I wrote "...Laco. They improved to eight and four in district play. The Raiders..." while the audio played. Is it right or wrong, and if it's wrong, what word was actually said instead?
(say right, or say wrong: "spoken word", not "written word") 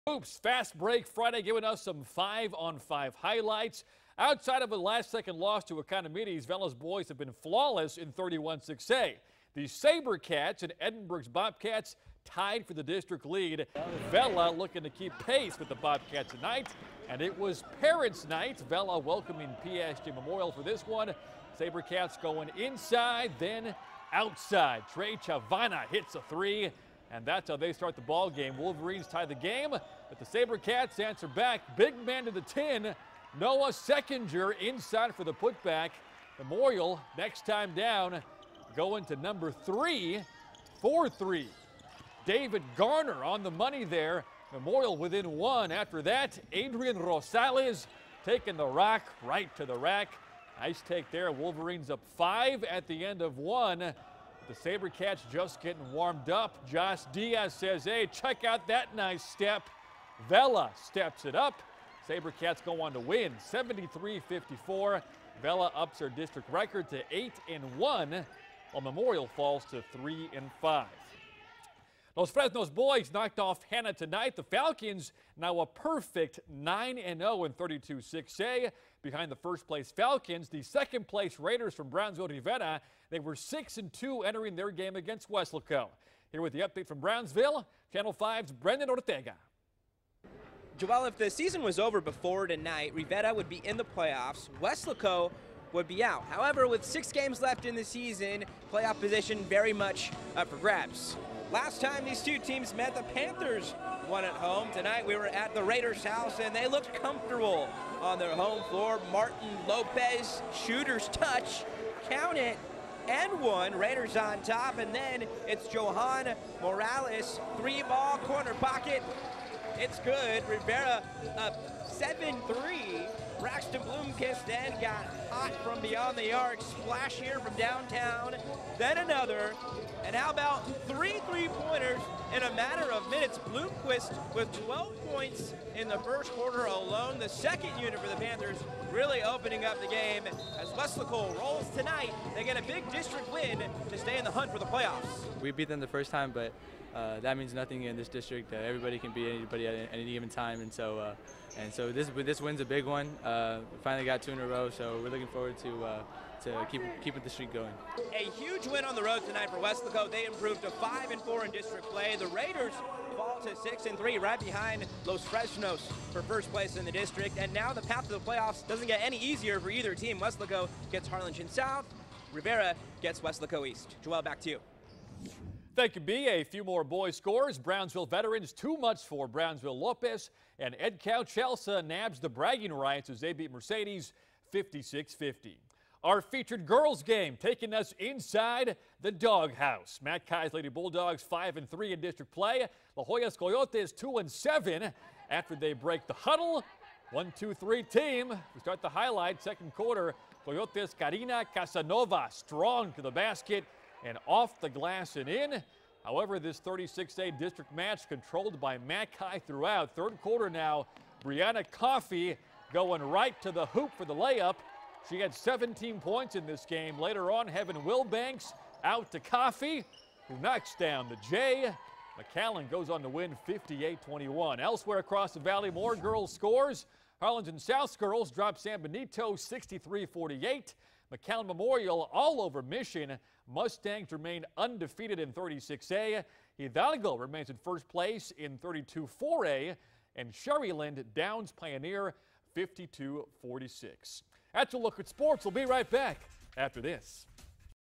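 wrong: "five", not "eight".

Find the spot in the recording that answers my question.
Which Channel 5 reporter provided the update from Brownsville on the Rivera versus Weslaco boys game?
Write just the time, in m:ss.
1:28.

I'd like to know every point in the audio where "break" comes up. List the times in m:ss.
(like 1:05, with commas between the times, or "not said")
0:00, 3:15.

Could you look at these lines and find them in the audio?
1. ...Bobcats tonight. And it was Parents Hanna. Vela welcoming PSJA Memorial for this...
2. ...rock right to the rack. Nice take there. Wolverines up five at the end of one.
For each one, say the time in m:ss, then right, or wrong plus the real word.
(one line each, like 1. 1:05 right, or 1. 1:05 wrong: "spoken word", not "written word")
1. 0:15 wrong: "Night", not "Hanna"
2. 0:48 right.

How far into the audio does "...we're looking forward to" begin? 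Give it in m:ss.
2:35.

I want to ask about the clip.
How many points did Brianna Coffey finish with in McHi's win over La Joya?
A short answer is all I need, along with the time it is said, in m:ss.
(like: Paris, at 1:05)
17, at 3:35.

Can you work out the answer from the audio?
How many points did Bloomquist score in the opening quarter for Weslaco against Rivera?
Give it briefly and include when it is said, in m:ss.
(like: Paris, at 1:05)
12, at 2:14.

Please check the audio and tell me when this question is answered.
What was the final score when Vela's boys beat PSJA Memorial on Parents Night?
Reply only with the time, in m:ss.
1:03.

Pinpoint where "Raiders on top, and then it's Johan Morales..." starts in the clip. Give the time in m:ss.
1:53.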